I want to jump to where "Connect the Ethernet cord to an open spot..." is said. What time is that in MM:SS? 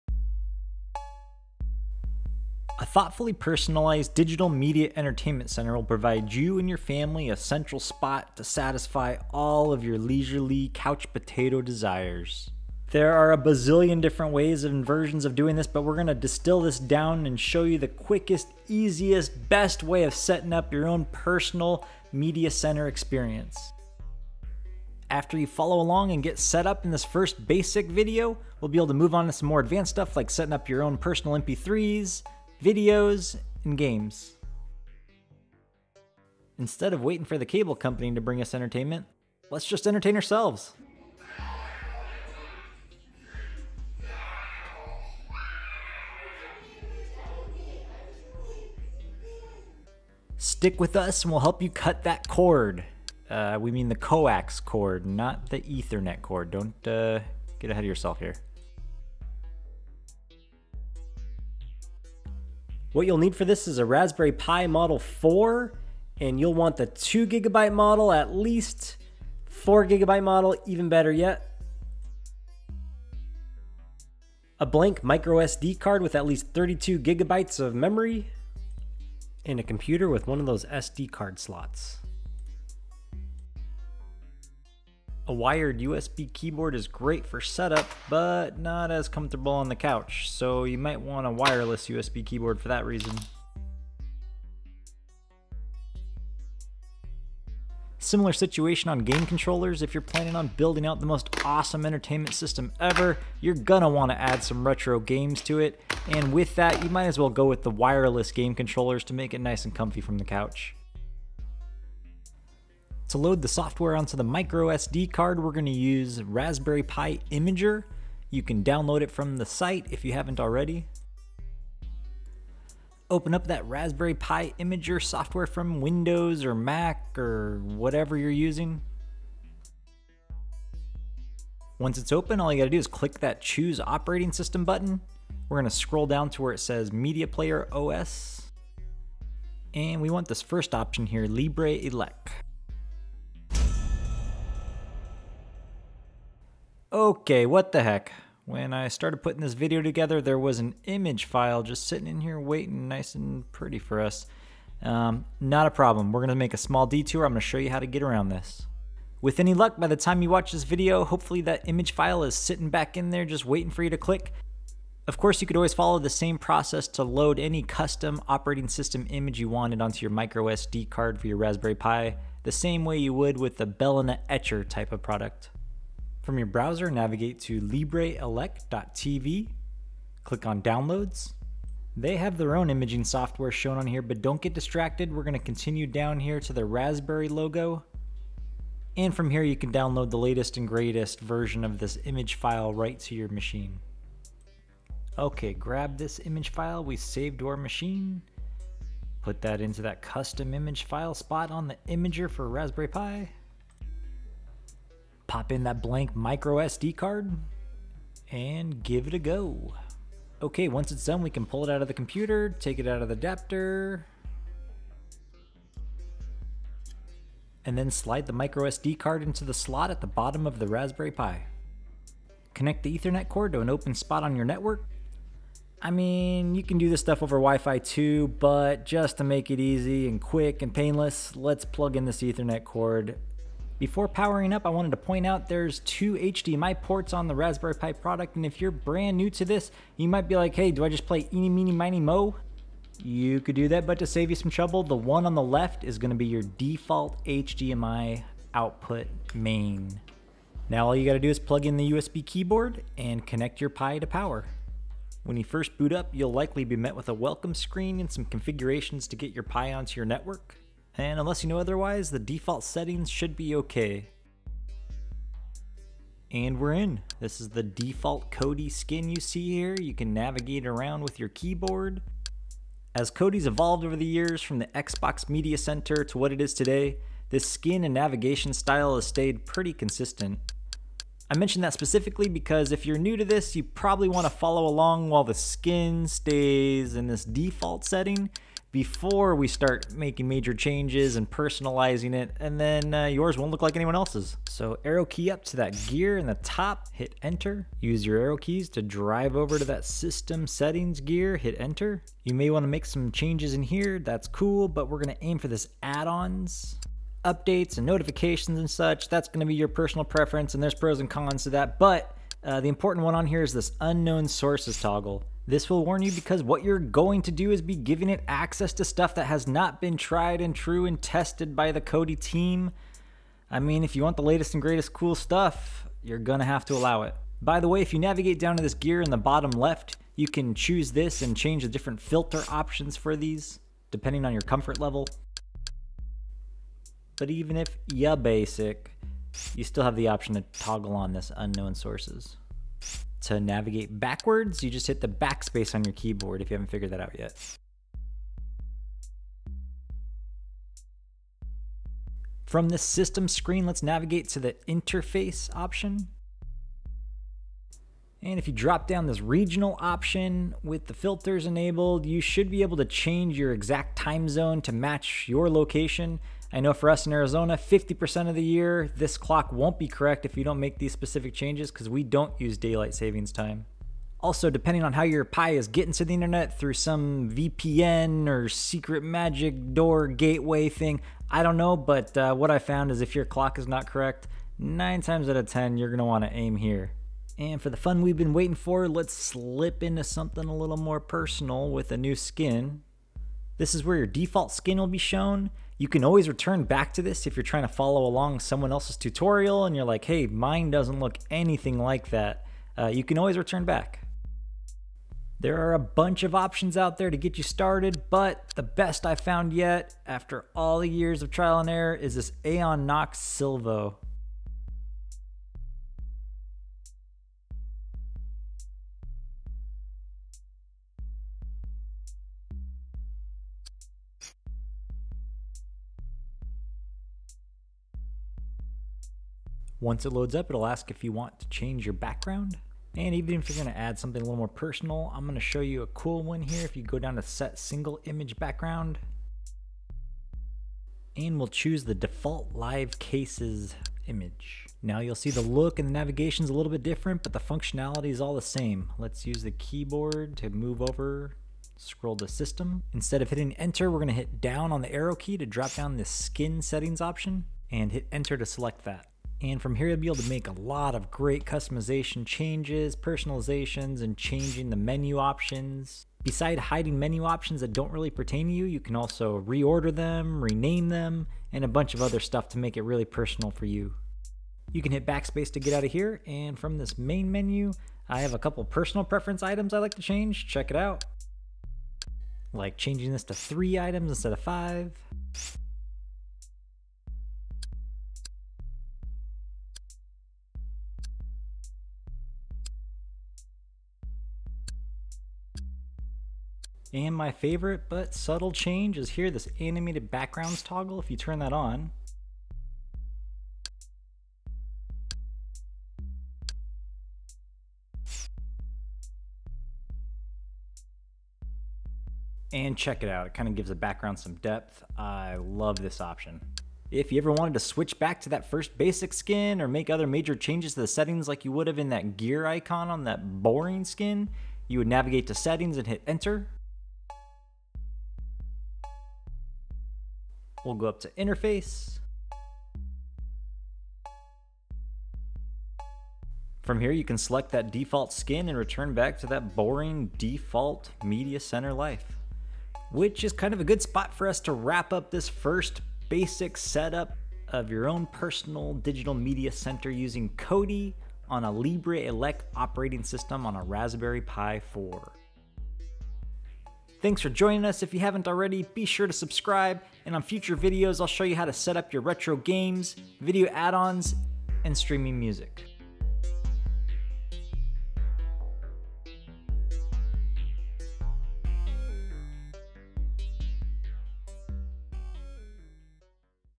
03:42.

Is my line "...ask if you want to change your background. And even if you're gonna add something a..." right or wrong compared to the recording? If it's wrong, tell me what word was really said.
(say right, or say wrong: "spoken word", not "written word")
right.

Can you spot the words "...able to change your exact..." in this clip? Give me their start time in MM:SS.
06:02.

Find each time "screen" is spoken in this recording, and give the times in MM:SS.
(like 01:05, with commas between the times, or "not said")
04:17, 05:53.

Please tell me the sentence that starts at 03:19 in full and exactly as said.
Put that into that custom image file spot on the imager for Raspberry Pi.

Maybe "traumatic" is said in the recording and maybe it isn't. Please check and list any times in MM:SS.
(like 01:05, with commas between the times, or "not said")
not said.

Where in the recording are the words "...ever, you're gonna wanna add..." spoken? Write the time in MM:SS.
01:42.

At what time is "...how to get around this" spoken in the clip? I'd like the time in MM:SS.
02:37.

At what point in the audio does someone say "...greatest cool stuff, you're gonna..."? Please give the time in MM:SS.
05:24.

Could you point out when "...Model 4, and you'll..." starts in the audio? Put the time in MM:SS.
01:04.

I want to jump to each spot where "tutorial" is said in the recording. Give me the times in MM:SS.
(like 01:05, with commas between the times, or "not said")
06:38.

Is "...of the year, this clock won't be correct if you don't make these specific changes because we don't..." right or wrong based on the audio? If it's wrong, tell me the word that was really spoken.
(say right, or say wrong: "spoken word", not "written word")
right.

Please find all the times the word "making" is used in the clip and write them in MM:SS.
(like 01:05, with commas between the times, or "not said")
04:49.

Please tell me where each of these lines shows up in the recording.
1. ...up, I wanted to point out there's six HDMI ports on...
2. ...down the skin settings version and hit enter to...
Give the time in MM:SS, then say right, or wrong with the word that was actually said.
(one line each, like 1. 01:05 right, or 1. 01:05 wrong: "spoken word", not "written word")
1. 03:54 wrong: "two", not "six"
2. 07:35 wrong: "option", not "version".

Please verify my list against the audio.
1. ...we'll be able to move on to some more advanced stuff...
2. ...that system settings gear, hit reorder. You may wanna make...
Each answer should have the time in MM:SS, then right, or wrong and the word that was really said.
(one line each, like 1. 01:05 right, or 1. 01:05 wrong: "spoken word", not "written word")
1. 00:28 right
2. 04:59 wrong: "enter", not "reorder".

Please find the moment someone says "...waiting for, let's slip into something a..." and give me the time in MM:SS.
06:28.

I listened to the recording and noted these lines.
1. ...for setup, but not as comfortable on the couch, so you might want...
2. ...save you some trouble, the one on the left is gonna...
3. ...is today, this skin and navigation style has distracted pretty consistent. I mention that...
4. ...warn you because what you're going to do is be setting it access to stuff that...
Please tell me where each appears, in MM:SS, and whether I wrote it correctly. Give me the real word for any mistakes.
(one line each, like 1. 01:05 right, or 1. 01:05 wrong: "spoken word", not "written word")
1. 01:27 right
2. 04:04 right
3. 04:36 wrong: "stayed", not "distracted"
4. 05:15 wrong: "giving", not "setting".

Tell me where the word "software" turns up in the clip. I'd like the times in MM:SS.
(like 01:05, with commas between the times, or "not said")
01:53, 02:05, 03:03.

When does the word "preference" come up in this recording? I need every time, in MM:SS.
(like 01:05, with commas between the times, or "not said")
05:10, 07:59.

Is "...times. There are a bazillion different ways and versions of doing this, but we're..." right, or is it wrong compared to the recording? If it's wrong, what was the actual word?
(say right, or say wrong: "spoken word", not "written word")
wrong: "desires", not "times".